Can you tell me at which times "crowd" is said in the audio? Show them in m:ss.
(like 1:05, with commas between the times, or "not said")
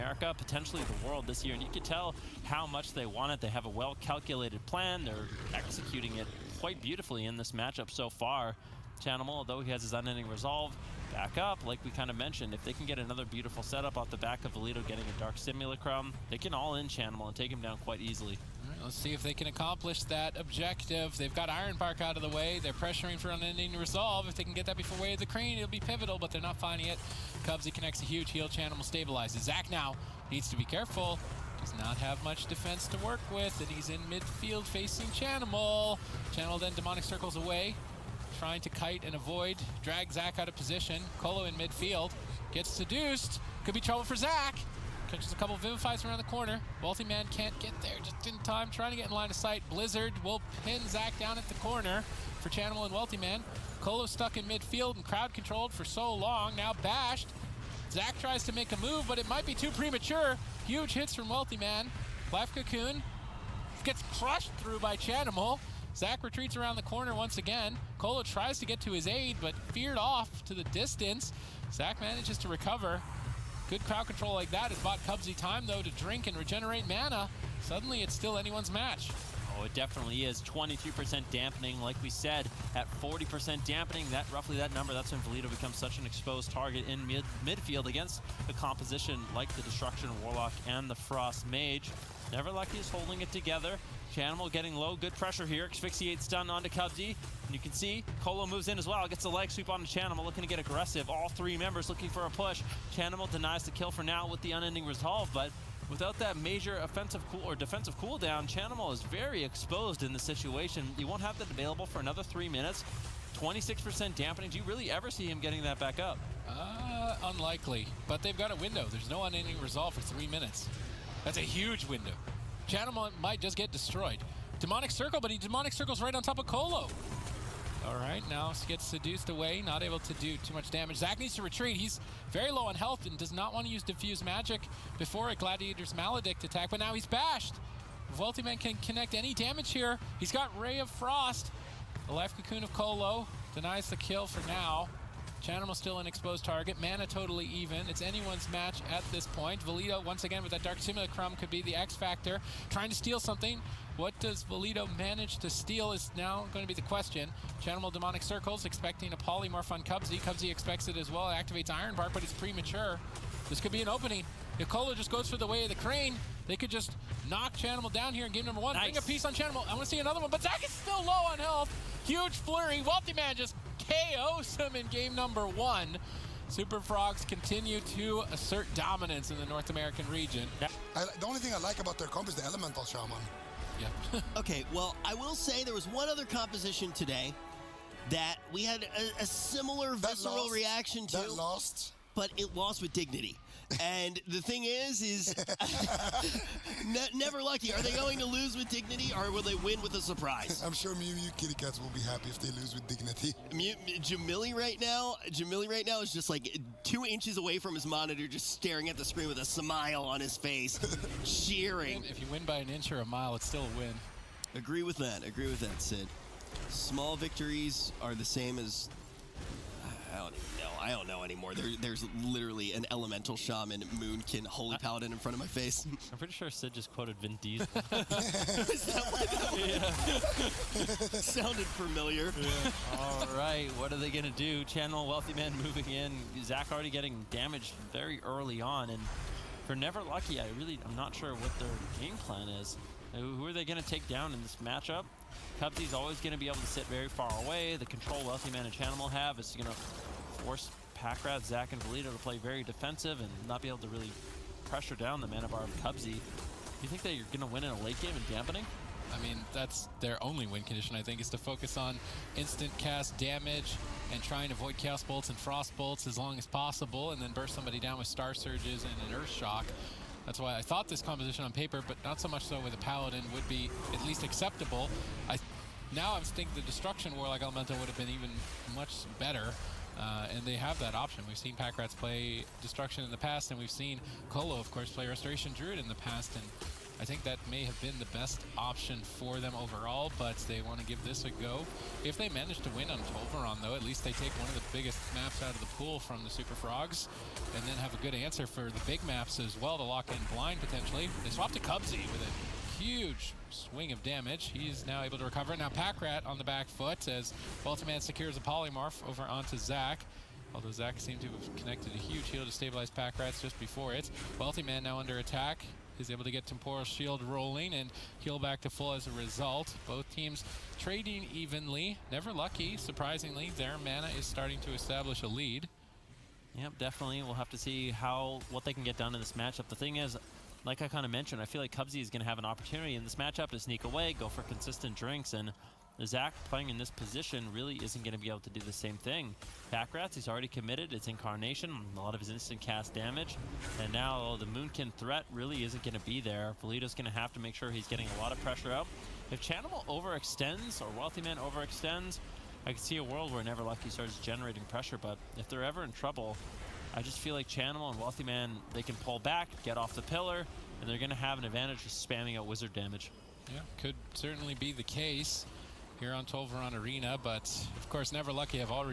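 0:55, 1:13.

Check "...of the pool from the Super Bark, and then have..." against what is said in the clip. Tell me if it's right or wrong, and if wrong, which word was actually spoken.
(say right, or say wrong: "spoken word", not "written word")
wrong: "Frogs", not "Bark".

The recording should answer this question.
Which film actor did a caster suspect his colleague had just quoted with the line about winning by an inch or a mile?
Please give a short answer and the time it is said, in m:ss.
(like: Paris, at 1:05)
Vin Diesel, at 3:47.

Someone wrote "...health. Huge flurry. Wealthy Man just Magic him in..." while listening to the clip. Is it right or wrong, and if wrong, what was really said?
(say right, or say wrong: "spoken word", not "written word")
wrong: "KOs", not "Magic".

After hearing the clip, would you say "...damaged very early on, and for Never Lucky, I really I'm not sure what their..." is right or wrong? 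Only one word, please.
right.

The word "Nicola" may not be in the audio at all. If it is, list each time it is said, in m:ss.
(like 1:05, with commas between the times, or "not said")
2:44.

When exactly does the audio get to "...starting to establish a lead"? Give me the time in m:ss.
5:24.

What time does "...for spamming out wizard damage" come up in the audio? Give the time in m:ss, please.
6:01.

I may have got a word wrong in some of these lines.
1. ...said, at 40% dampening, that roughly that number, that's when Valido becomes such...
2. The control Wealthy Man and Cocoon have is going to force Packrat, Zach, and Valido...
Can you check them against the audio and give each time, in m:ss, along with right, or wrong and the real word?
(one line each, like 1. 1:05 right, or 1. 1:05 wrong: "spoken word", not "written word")
1. 1:22 right
2. 4:07 wrong: "Chanimal", not "Cocoon".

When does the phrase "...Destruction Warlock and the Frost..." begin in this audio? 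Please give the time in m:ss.
1:29.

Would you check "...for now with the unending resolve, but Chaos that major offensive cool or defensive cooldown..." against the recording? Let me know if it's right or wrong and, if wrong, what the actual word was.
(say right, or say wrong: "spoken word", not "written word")
wrong: "Without", not "Chaos".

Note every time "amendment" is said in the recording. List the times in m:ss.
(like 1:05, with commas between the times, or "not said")
not said.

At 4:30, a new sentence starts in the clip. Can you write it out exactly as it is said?
That's why I thought this composition on paper, but not so much so with a Paladin, would be at least acceptable.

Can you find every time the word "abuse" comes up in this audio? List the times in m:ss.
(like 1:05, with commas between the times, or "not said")
not said.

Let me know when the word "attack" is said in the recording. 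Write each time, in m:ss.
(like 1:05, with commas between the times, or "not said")
2:16, 5:15.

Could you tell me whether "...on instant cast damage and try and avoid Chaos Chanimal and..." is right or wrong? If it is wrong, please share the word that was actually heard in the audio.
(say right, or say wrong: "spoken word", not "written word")
wrong: "Bolts", not "Chanimal".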